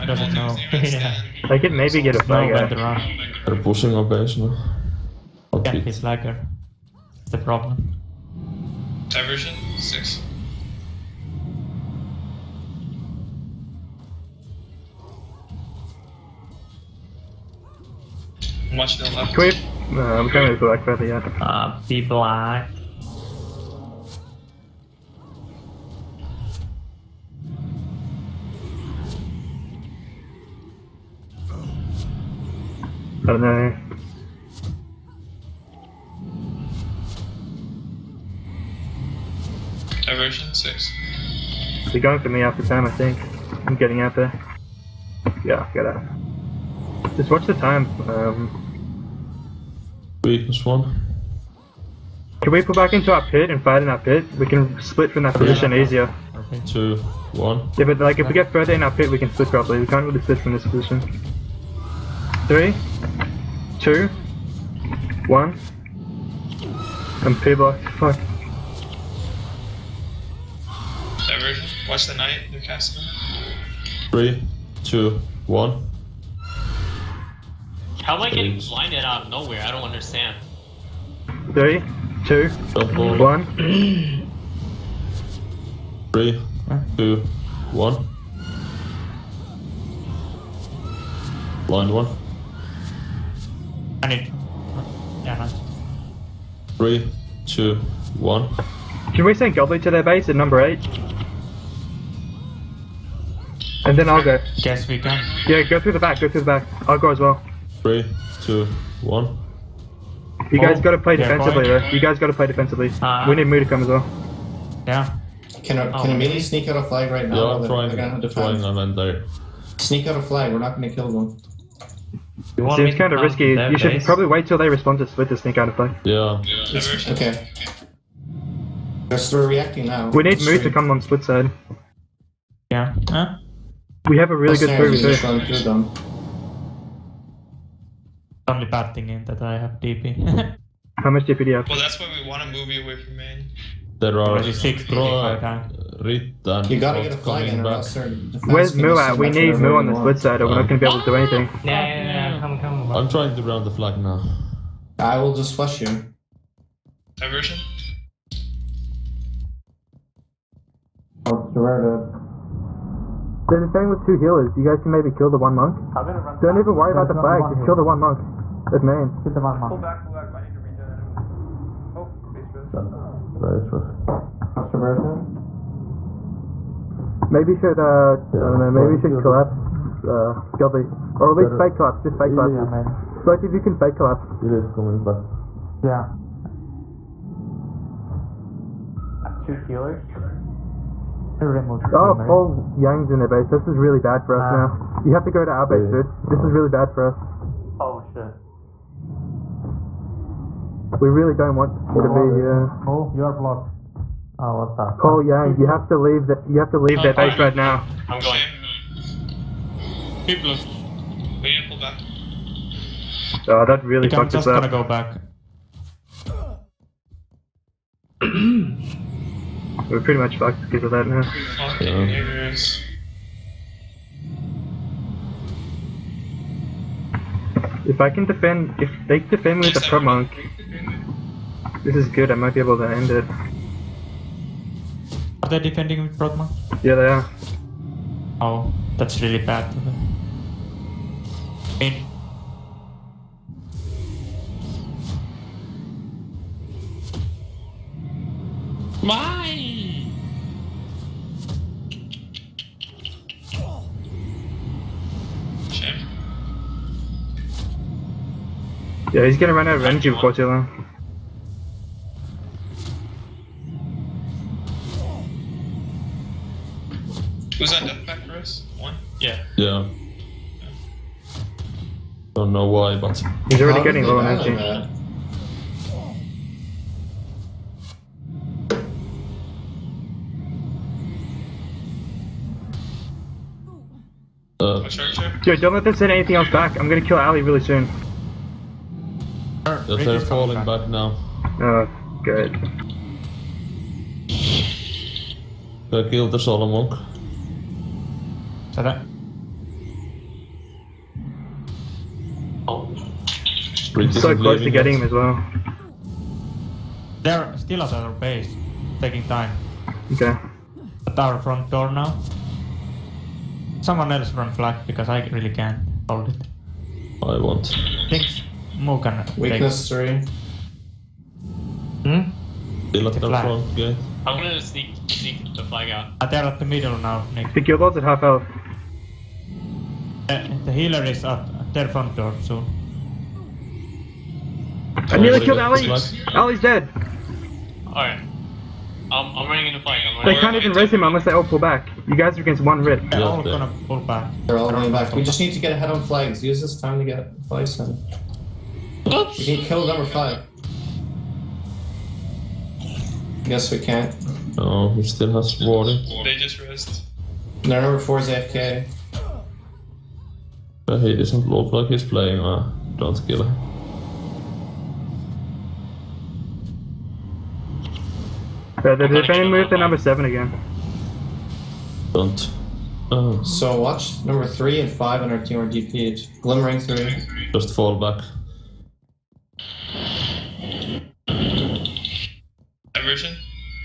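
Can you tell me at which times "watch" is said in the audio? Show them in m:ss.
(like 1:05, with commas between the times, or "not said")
0:18, 0:47, 1:11, 6:13.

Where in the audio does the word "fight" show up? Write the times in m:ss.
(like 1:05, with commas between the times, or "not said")
0:53, 5:39.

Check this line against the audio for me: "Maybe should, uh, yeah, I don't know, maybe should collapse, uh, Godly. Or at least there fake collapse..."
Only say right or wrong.
right.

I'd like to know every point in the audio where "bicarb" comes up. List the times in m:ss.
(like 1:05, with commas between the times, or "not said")
not said.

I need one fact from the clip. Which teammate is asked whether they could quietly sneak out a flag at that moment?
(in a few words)
Amelia.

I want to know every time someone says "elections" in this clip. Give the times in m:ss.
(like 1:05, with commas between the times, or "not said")
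not said.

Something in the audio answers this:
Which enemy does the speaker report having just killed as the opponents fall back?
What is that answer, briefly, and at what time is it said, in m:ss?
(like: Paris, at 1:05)
the Solomon, at 4:56.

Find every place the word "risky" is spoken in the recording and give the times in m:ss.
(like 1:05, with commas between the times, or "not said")
2:03.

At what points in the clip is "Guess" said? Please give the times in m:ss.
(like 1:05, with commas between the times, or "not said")
5:53.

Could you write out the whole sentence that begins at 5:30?
Uh, the healer is at their front door soon.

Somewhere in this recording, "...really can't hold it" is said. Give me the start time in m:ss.
5:15.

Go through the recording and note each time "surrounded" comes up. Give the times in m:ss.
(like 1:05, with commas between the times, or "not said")
2:41.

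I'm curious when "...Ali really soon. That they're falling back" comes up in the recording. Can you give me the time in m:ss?
4:47.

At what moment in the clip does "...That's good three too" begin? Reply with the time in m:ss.
2:14.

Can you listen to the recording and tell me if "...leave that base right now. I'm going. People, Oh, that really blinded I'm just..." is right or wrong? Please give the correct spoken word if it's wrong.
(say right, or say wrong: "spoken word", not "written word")
wrong: "fucked", not "blinded".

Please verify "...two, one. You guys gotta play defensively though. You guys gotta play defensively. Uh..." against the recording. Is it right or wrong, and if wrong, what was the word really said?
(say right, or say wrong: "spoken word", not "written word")
right.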